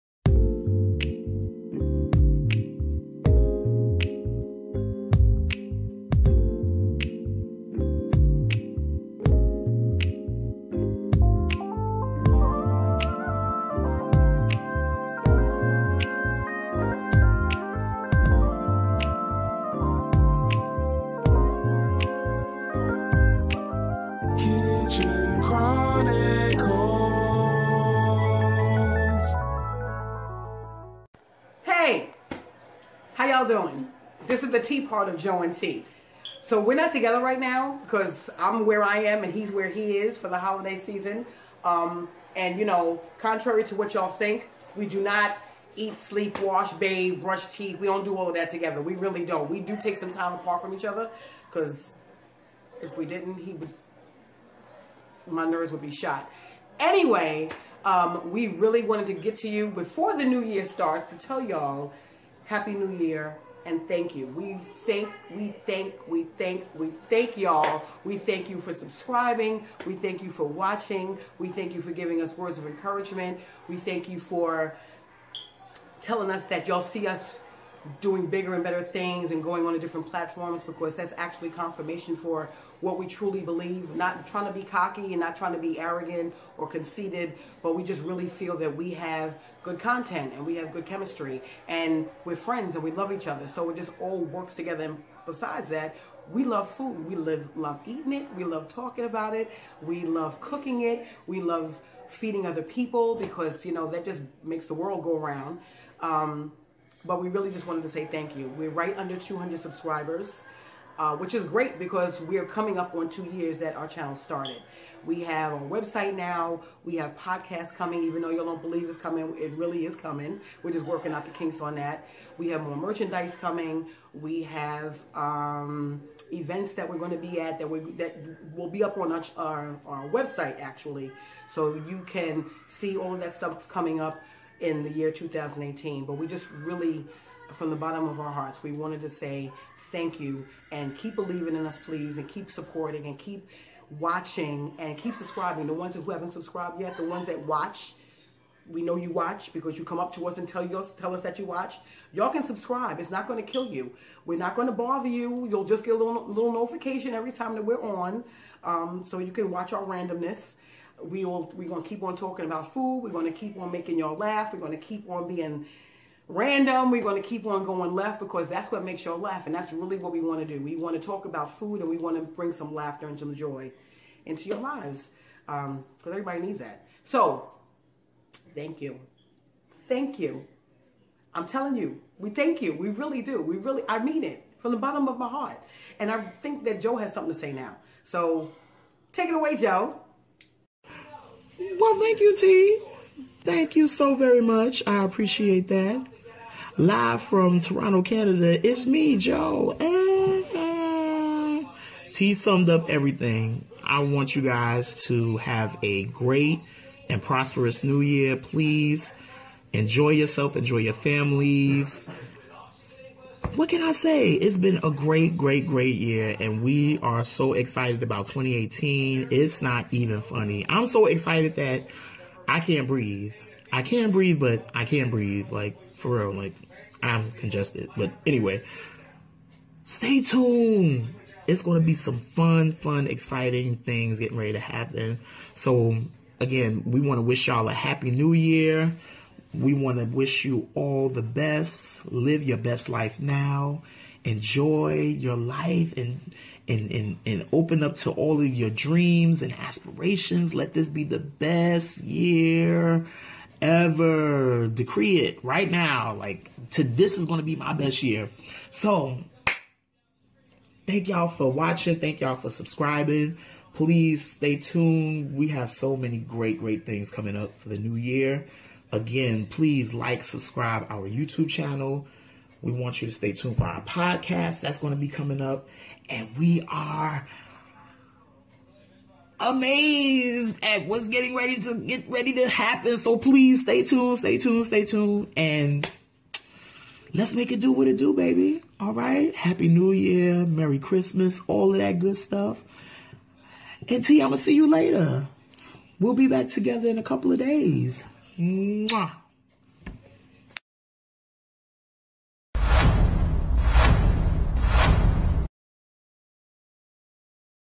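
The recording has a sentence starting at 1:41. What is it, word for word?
We love feeding other people because, you know, that just makes the world go around.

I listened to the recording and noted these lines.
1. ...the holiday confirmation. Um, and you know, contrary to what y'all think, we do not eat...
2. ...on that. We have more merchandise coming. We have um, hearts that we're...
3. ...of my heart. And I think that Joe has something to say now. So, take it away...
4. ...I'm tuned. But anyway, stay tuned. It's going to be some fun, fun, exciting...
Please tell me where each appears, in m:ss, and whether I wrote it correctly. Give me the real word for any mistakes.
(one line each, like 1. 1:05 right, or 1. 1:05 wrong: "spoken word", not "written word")
1. 0:40 wrong: "season", not "confirmation"
2. 2:01 wrong: "events", not "hearts"
3. 3:05 right
4. 3:47 wrong: "congested", not "tuned".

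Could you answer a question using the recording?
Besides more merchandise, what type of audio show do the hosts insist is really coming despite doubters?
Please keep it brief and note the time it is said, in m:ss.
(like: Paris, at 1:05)
podcasts, at 1:57.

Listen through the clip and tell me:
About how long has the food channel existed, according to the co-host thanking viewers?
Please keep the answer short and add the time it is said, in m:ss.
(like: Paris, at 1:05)
two years, at 1:53.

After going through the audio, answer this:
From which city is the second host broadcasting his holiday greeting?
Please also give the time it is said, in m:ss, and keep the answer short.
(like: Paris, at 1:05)
Toronto, at 3:17.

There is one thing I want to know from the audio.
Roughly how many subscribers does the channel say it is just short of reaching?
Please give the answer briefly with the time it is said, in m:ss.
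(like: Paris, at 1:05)
200, at 1:49.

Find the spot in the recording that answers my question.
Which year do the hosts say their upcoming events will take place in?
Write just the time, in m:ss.
2:14.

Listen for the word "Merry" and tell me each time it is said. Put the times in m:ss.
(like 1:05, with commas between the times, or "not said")
4:50.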